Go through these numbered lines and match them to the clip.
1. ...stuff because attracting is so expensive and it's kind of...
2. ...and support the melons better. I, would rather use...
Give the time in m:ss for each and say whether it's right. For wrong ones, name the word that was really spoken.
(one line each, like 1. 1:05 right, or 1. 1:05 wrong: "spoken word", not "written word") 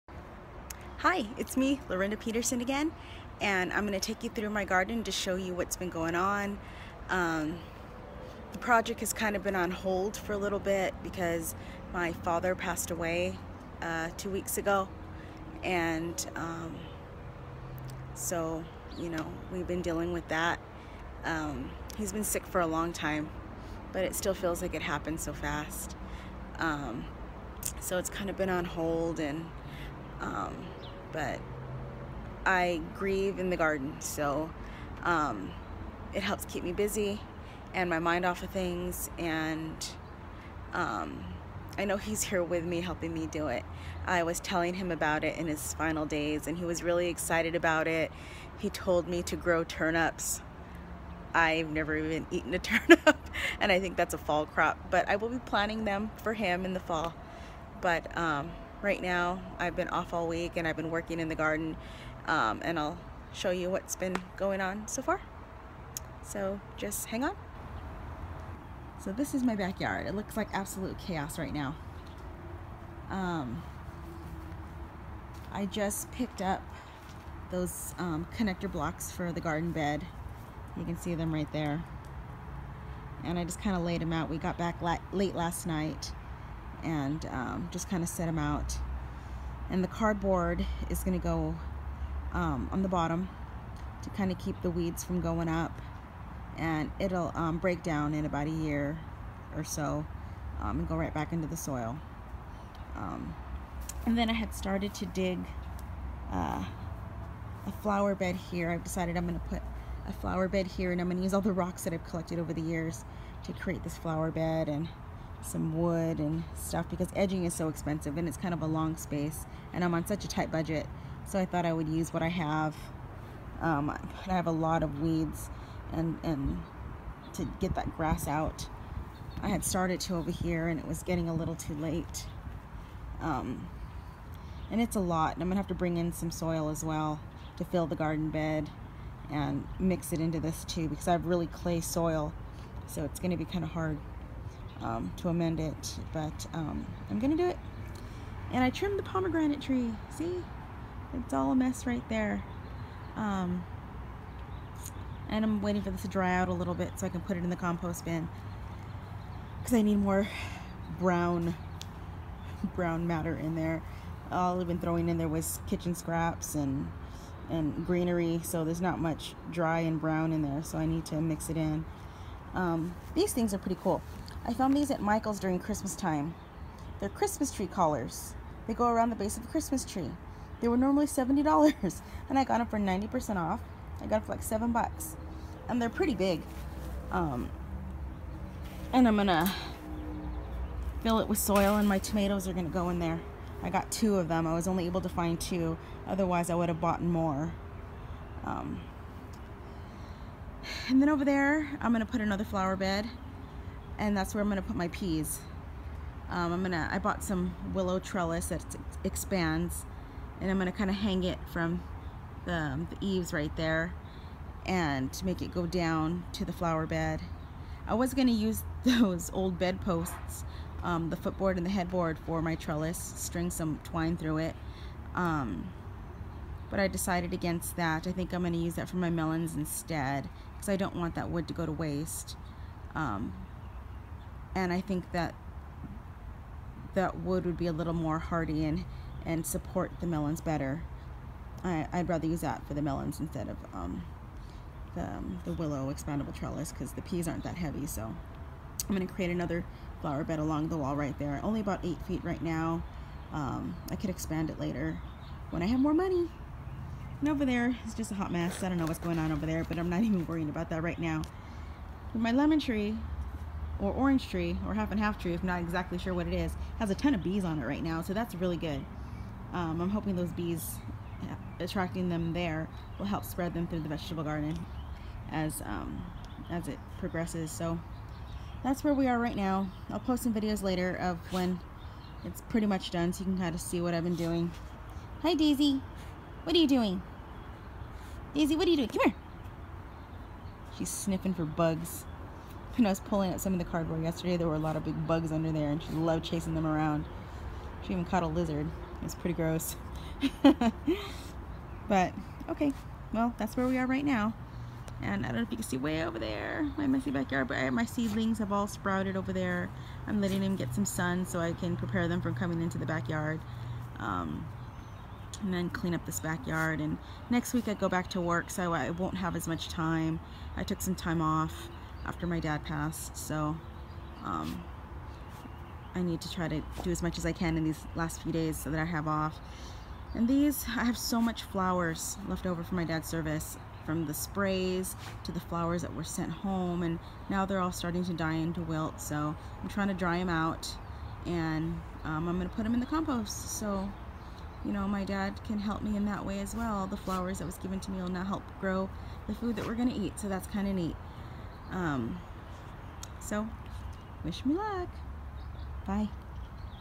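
1. 1:56 wrong: "edging", not "attracting"
2. 3:59 right.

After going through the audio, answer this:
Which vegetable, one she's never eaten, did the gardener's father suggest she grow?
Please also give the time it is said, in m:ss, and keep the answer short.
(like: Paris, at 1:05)
turnips, at 0:49.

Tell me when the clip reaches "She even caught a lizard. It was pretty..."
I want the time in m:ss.
4:57.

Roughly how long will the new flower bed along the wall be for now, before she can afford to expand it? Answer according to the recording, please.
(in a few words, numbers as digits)
8 feet.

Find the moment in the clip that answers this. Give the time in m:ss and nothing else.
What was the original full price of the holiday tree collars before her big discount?
3:01.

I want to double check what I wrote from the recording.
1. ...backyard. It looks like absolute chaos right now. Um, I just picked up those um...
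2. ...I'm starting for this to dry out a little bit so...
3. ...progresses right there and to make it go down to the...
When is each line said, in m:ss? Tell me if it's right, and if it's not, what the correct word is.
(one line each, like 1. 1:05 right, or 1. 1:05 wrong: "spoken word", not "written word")
1. 1:09 right
2. 2:35 wrong: "waiting", not "starting"
3. 3:32 wrong: "eaves", not "progresses".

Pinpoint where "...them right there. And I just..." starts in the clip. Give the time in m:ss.
1:21.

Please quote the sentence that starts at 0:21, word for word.
Um, he's been sick for a long time, but it still feels like it happened so fast.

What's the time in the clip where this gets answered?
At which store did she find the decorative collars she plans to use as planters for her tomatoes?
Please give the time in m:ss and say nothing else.
2:55.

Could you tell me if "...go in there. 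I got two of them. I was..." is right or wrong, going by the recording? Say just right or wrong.
right.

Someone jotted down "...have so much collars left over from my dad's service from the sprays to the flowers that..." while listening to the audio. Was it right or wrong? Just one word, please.
wrong.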